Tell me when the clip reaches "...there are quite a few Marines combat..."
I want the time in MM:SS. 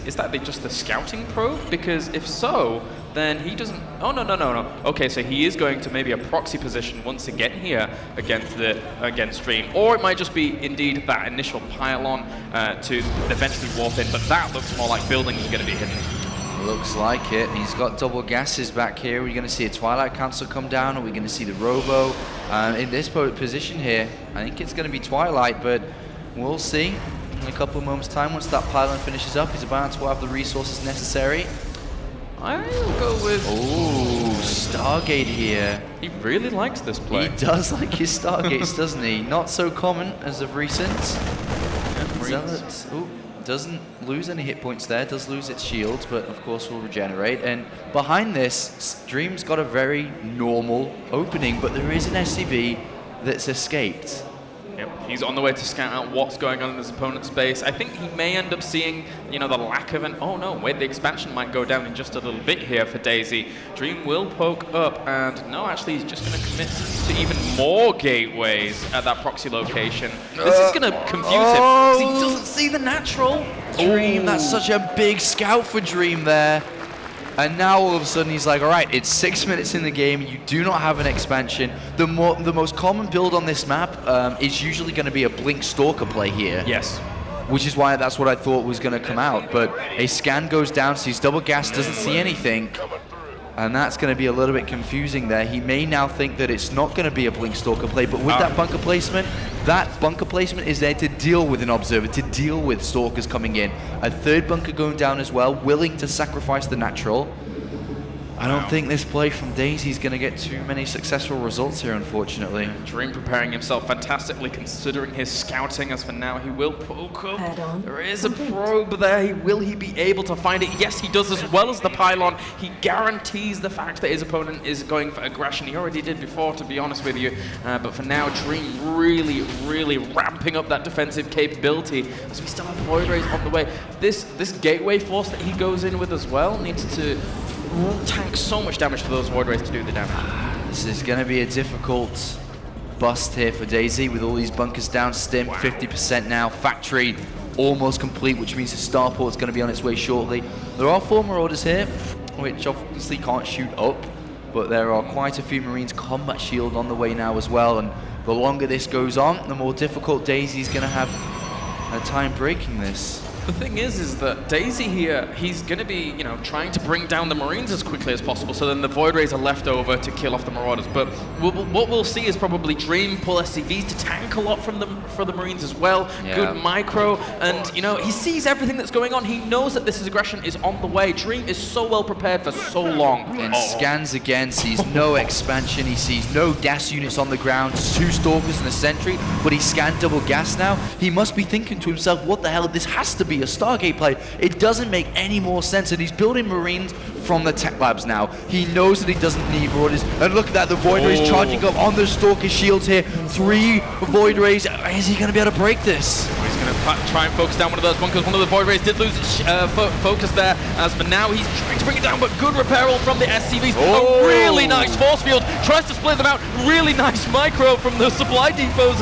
02:34.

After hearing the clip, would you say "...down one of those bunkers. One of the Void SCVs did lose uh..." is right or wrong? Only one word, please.
wrong.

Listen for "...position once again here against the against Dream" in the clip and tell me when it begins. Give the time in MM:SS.
00:06.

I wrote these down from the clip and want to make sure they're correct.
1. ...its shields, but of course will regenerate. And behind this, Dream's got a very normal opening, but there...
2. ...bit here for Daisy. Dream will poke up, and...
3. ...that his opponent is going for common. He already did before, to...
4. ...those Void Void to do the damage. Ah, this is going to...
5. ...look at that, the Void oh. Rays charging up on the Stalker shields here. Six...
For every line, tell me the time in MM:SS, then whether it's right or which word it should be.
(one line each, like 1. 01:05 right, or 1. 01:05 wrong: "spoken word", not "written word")
1. 00:45 right
2. 01:02 right
3. 02:04 wrong: "aggression", not "common"
4. 02:19 wrong: "Rays", not "Void"
5. 03:20 wrong: "Three", not "Six".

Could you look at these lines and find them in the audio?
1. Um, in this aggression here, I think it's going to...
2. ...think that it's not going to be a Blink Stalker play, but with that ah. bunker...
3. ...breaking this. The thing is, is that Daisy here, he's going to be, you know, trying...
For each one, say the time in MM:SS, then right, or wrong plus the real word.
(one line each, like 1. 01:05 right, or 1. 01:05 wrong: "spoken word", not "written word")
1. 00:22 wrong: "position", not "aggression"
2. 01:36 right
3. 02:42 right.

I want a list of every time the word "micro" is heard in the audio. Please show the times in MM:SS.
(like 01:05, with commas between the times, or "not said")
02:56, 03:37.